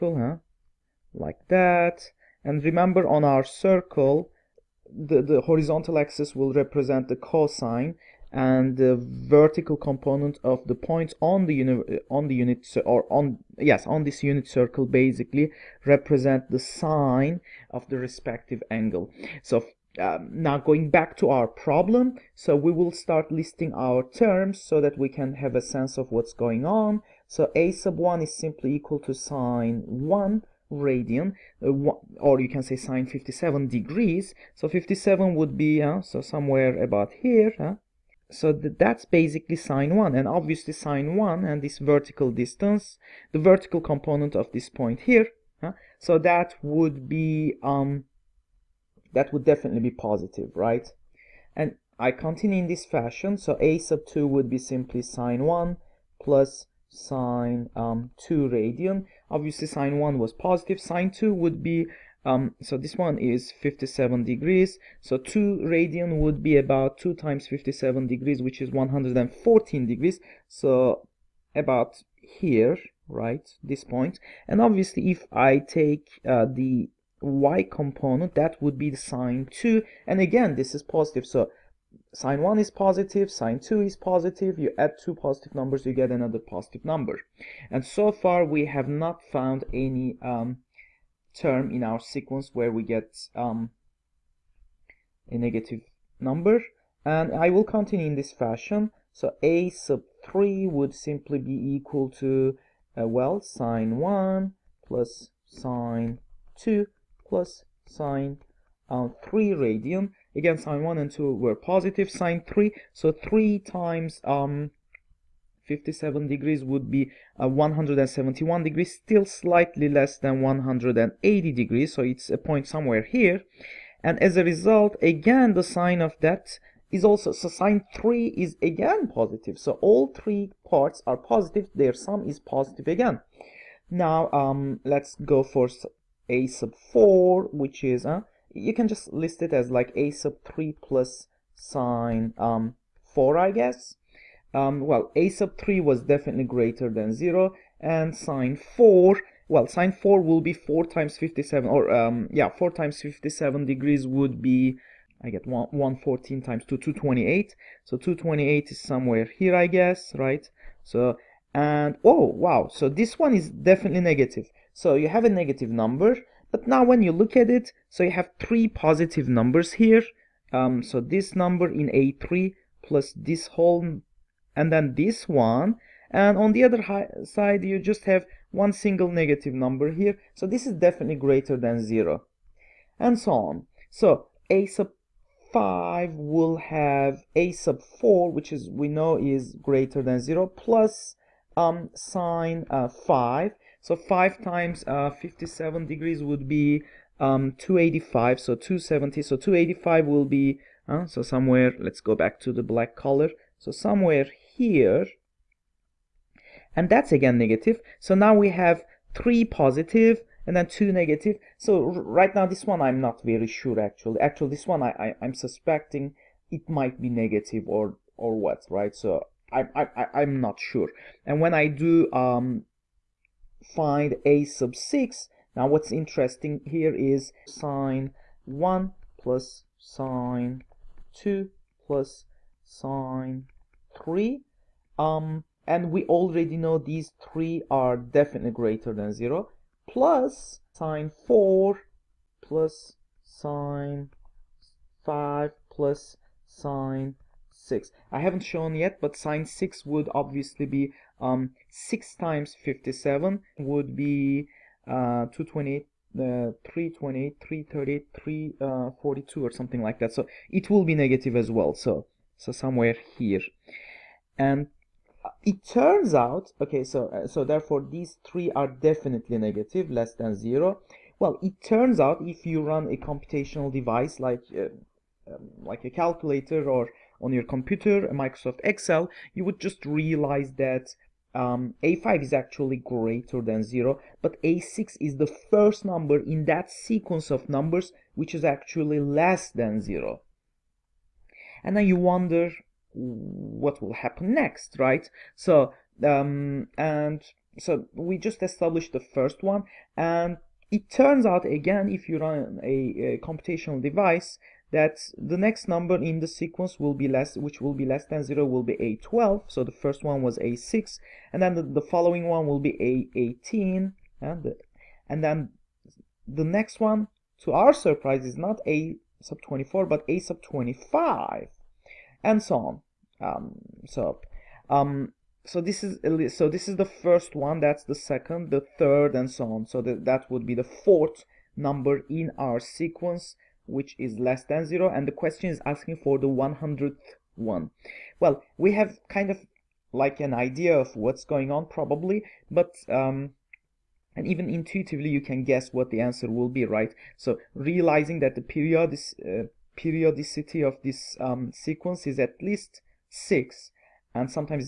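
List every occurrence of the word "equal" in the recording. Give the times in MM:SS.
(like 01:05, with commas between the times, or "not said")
00:28, 01:41.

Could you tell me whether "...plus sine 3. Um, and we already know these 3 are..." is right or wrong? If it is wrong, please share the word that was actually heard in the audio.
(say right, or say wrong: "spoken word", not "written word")
right.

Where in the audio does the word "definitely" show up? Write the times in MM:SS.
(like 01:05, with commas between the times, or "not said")
00:49, 02:26, 02:43, 03:00, 03:57, 04:28.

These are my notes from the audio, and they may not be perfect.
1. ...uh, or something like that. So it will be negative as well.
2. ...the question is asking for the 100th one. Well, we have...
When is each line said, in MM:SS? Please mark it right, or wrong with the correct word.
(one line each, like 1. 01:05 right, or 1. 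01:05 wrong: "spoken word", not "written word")
1. 04:18 right
2. 05:35 right.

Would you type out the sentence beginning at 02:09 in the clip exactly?
So all three parts are positive, their sum is positive again.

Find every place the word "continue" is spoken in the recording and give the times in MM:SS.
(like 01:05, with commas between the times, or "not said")
00:52, 01:37.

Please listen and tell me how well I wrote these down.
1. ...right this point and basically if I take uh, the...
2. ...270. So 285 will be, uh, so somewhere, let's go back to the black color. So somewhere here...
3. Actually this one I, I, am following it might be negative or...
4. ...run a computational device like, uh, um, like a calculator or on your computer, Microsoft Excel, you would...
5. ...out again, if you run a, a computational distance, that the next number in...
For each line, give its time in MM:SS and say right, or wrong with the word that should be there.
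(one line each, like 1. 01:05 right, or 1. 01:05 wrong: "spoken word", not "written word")
1. 01:13 wrong: "obviously", not "basically"
2. 03:18 right
3. 03:34 wrong: "suspecting", not "following"
4. 04:32 right
5. 05:01 wrong: "device", not "distance".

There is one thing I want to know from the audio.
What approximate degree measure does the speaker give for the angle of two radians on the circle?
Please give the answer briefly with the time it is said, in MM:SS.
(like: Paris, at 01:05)
114 degrees, at 01:08.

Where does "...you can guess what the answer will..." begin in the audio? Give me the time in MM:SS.
05:45.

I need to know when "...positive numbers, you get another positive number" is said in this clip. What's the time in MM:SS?
01:25.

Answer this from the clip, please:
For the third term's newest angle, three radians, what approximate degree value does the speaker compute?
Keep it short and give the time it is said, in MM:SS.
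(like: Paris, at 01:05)
171 degrees, at 01:57.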